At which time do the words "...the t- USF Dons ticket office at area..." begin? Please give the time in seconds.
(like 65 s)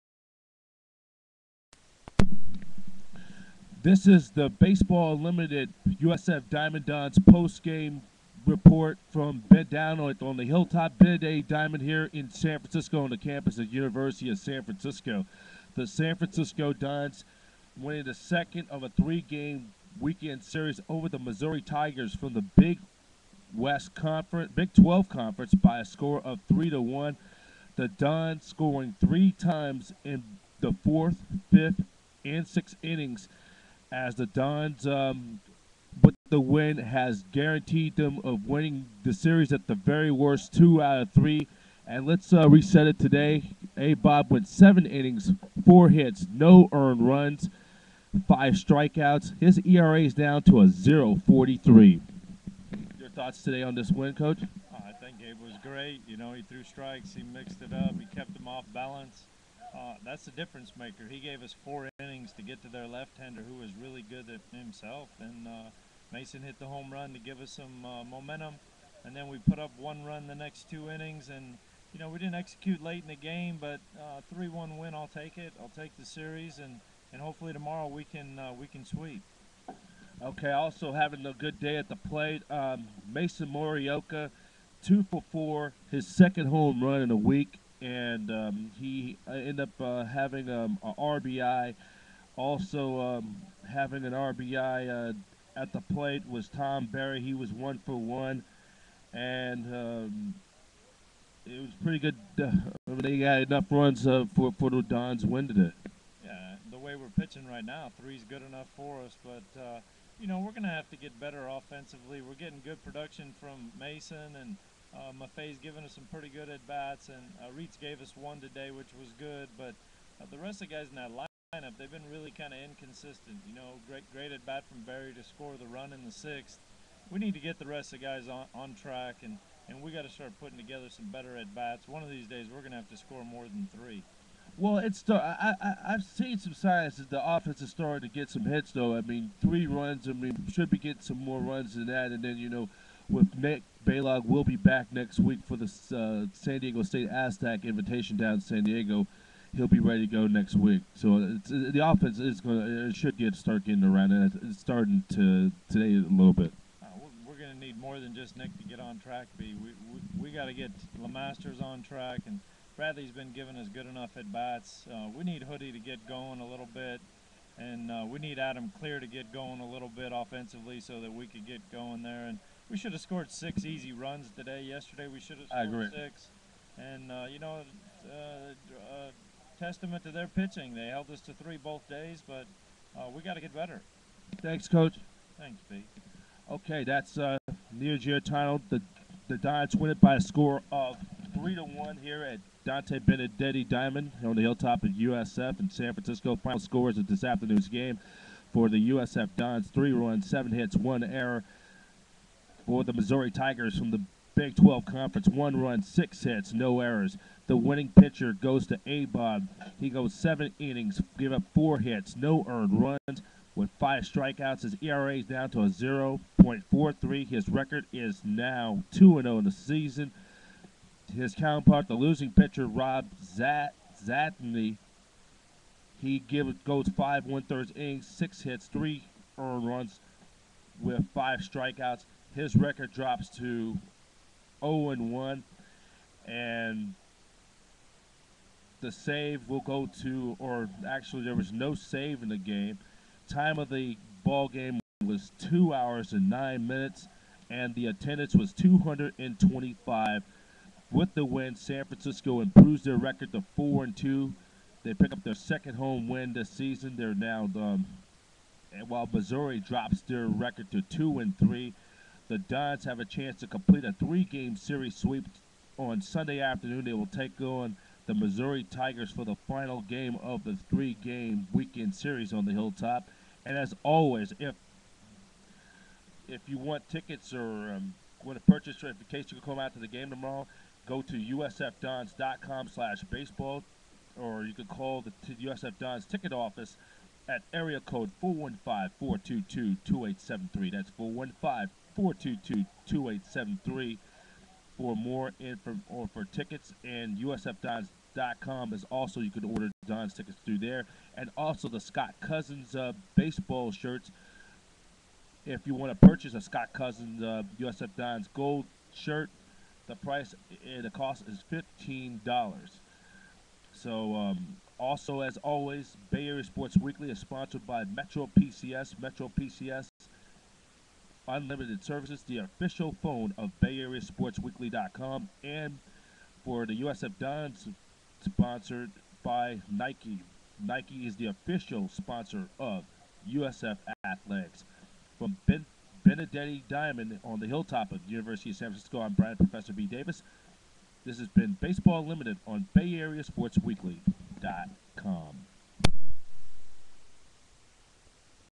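285 s.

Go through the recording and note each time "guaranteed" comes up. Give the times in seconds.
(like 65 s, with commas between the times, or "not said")
37 s.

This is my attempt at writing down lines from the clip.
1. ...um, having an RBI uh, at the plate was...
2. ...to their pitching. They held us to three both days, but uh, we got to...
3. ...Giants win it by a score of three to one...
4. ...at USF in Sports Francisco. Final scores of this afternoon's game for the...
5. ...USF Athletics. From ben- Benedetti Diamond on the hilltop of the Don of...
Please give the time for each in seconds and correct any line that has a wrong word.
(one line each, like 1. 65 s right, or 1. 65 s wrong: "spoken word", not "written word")
1. 92 s right
2. 180 s right
3. 189 s right
4. 194 s wrong: "San", not "Sports"
5. 333 s wrong: "University", not "Don".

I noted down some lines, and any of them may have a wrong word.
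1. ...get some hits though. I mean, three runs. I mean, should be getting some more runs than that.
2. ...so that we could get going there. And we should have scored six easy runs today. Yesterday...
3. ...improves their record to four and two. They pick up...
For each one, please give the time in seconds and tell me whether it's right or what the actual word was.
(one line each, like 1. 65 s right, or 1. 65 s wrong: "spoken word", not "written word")
1. 138 s right
2. 170 s right
3. 252 s right.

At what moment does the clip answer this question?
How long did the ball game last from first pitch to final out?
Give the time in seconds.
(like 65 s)
245 s.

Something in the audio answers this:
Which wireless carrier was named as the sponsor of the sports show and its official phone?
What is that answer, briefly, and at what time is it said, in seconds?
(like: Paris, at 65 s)
Metro PCS, at 319 s.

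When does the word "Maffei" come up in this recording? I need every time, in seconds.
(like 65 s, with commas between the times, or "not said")
115 s.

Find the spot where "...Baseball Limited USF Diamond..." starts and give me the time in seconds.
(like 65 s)
4 s.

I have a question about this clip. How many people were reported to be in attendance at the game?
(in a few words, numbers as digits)
225.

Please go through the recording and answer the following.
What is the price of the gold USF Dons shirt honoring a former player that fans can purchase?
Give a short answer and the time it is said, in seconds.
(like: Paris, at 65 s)
$15, at 311 s.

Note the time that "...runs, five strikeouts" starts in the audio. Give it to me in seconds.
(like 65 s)
47 s.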